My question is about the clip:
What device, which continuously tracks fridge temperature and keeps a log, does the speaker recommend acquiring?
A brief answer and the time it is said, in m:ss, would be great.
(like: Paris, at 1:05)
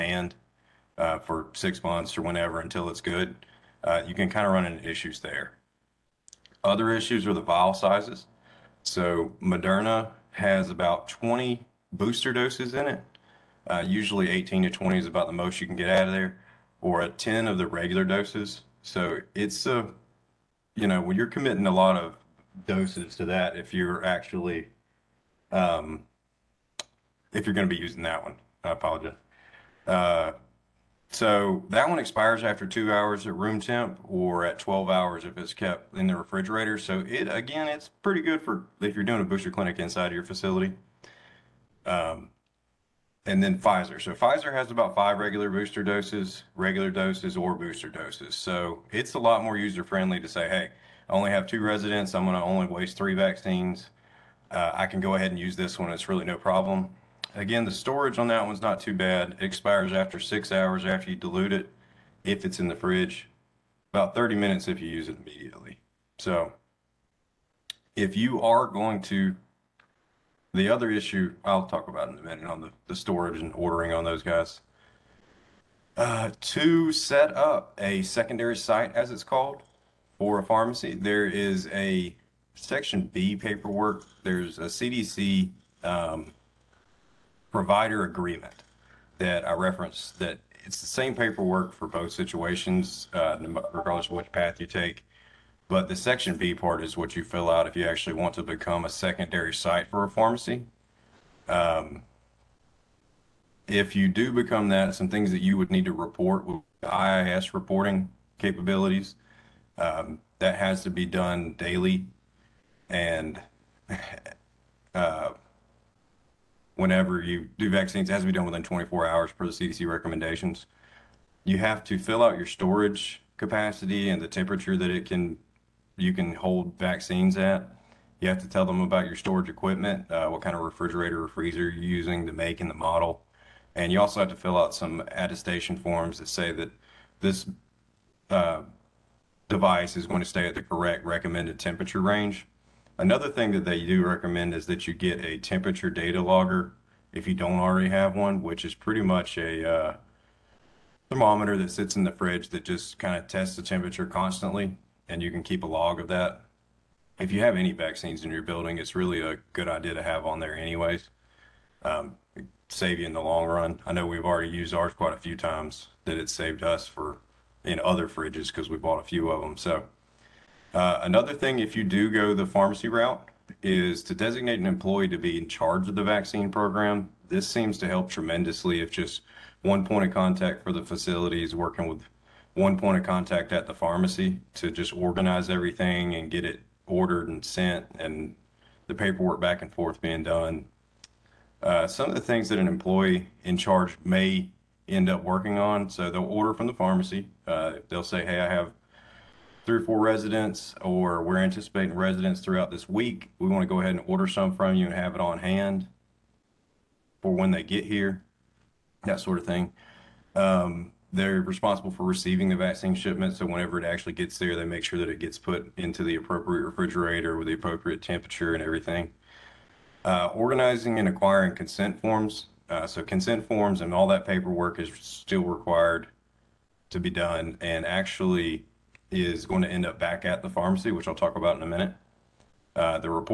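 Temperature data logger, at 2:25.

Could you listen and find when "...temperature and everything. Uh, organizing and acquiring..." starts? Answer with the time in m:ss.
3:38.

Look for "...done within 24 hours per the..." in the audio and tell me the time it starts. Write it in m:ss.
1:58.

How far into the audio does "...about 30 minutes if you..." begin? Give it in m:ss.
1:03.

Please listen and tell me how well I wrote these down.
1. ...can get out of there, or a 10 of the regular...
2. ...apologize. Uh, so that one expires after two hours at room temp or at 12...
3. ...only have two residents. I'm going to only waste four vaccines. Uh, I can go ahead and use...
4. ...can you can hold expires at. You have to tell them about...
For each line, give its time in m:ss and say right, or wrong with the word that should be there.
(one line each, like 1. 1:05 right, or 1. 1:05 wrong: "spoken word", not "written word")
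1. 0:15 right
2. 0:28 right
3. 0:51 wrong: "three", not "four"
4. 2:05 wrong: "vaccines", not "expires".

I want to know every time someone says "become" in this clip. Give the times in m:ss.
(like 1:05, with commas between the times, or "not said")
1:38, 1:44.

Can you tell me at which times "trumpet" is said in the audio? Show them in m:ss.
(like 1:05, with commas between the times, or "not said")
not said.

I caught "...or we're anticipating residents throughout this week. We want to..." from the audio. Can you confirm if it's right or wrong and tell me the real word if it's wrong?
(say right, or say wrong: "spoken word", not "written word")
right.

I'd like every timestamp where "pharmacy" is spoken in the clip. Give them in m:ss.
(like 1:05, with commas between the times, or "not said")
1:20, 1:40, 2:52, 3:03, 3:16, 3:50.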